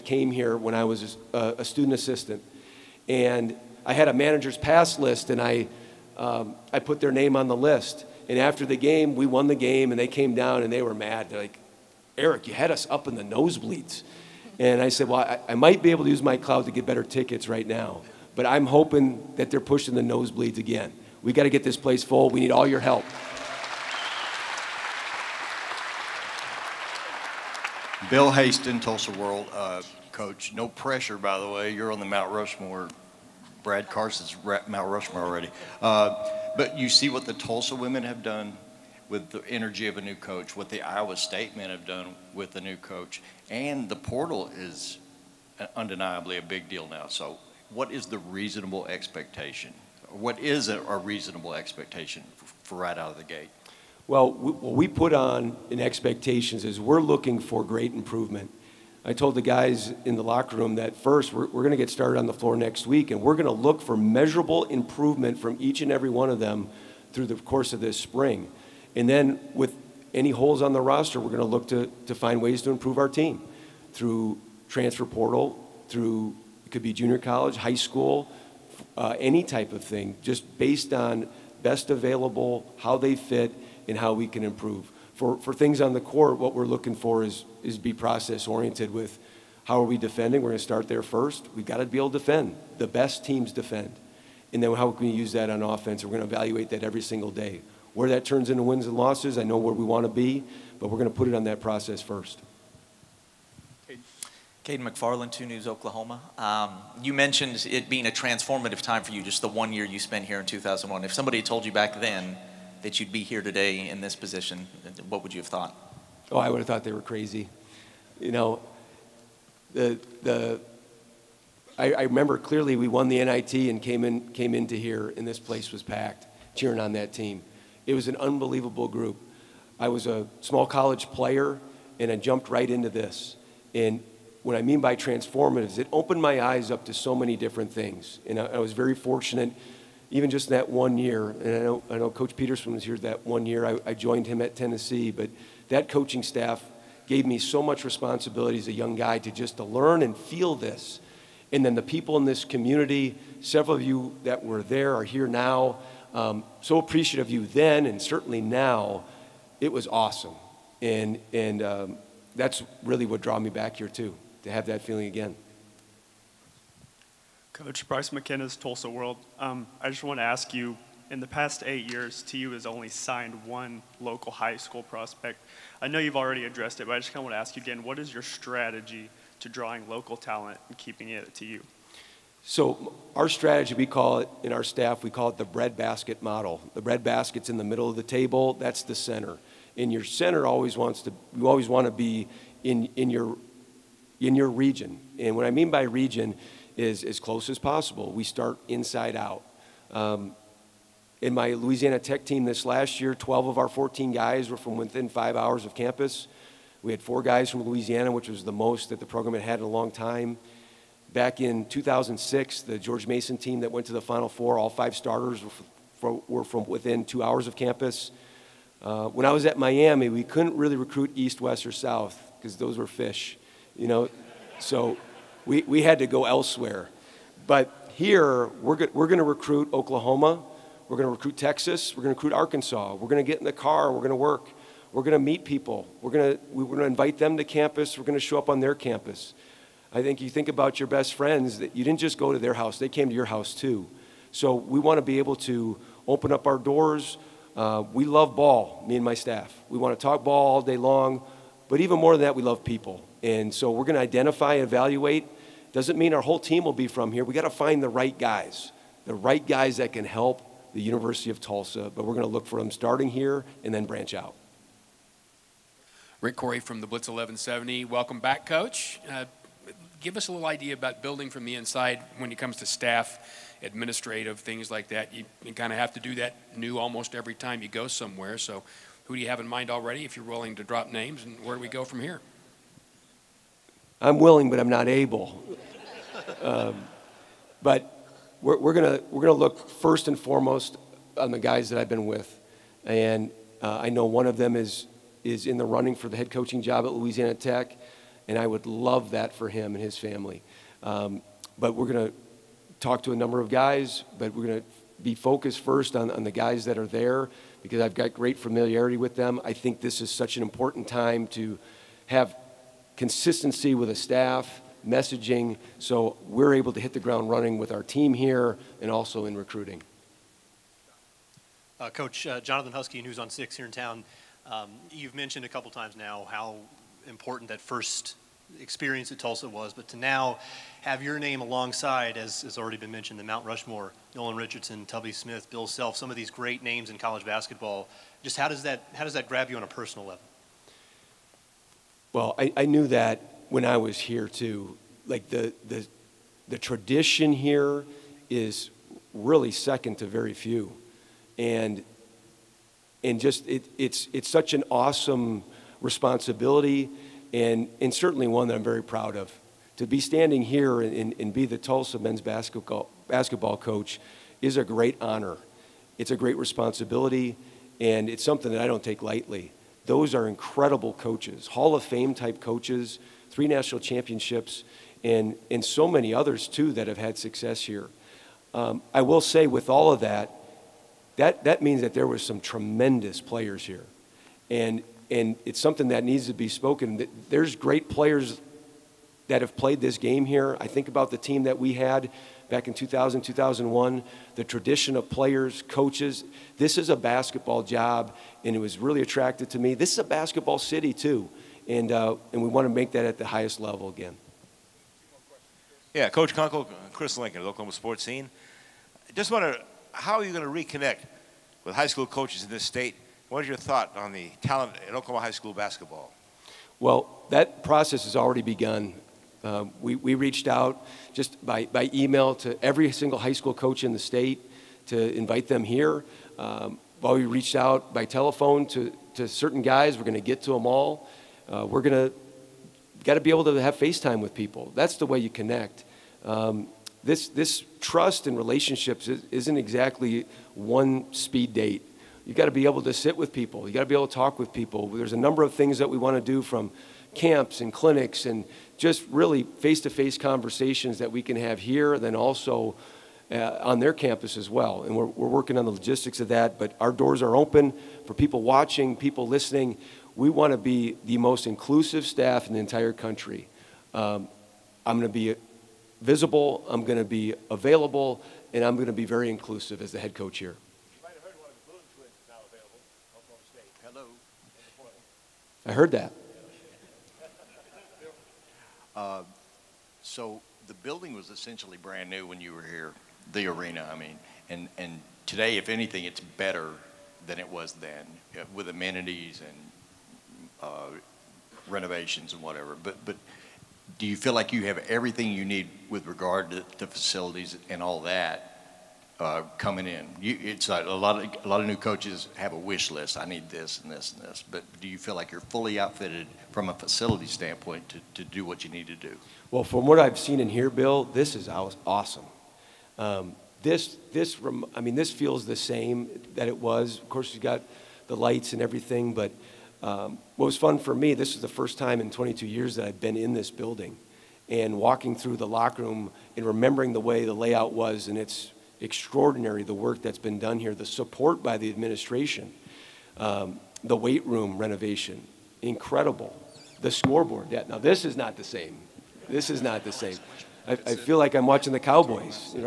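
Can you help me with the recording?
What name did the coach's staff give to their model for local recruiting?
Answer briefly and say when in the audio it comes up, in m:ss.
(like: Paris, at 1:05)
breadbasket model, at 3:05.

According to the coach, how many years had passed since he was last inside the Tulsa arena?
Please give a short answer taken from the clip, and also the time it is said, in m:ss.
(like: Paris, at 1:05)
22, at 8:42.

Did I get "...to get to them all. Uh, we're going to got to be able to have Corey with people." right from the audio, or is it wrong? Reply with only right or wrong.
wrong.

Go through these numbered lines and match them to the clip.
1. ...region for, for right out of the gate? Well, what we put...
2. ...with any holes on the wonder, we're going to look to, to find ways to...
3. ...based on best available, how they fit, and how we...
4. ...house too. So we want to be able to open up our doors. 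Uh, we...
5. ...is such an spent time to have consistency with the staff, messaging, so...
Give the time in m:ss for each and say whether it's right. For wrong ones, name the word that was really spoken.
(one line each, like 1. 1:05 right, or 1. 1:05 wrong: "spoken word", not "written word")
1. 0:51 wrong: "expectation", not "region"
2. 1:09 wrong: "roster", not "wonder"
3. 1:20 right
4. 4:03 right
5. 5:10 wrong: "important", not "spent".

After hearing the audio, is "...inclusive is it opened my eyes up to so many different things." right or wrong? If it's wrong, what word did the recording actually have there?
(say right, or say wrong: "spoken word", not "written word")
wrong: "transformative", not "inclusive".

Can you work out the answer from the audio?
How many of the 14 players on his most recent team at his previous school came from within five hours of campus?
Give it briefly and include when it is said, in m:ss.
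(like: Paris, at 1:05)
12, at 3:23.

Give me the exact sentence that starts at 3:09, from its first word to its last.
And your center always wants to, you always want to be in, in, your, in your region.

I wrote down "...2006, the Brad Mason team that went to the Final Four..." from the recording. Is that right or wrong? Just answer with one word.
wrong.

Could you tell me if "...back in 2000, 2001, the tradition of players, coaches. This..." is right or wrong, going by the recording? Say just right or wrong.
right.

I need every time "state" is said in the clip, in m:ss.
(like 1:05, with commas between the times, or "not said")
0:41, 6:52, 7:03.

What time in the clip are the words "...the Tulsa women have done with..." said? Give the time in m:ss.
0:37.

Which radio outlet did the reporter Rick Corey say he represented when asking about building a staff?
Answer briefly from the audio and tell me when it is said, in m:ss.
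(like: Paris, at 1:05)
the Blitz 1170, at 4:26.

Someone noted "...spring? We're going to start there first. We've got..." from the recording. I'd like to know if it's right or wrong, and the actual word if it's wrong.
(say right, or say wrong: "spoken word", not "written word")
wrong: "defending", not "spring".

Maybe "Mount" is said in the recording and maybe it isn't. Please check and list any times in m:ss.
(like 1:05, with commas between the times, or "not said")
0:32, 5:33.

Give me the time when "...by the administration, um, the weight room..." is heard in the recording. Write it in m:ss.
8:51.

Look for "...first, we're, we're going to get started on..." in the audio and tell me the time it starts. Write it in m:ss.
1:00.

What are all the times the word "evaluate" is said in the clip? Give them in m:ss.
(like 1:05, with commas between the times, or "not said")
1:36, 4:14.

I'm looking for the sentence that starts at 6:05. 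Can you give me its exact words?
It's a great responsibility, and it's something that I don't take lightly.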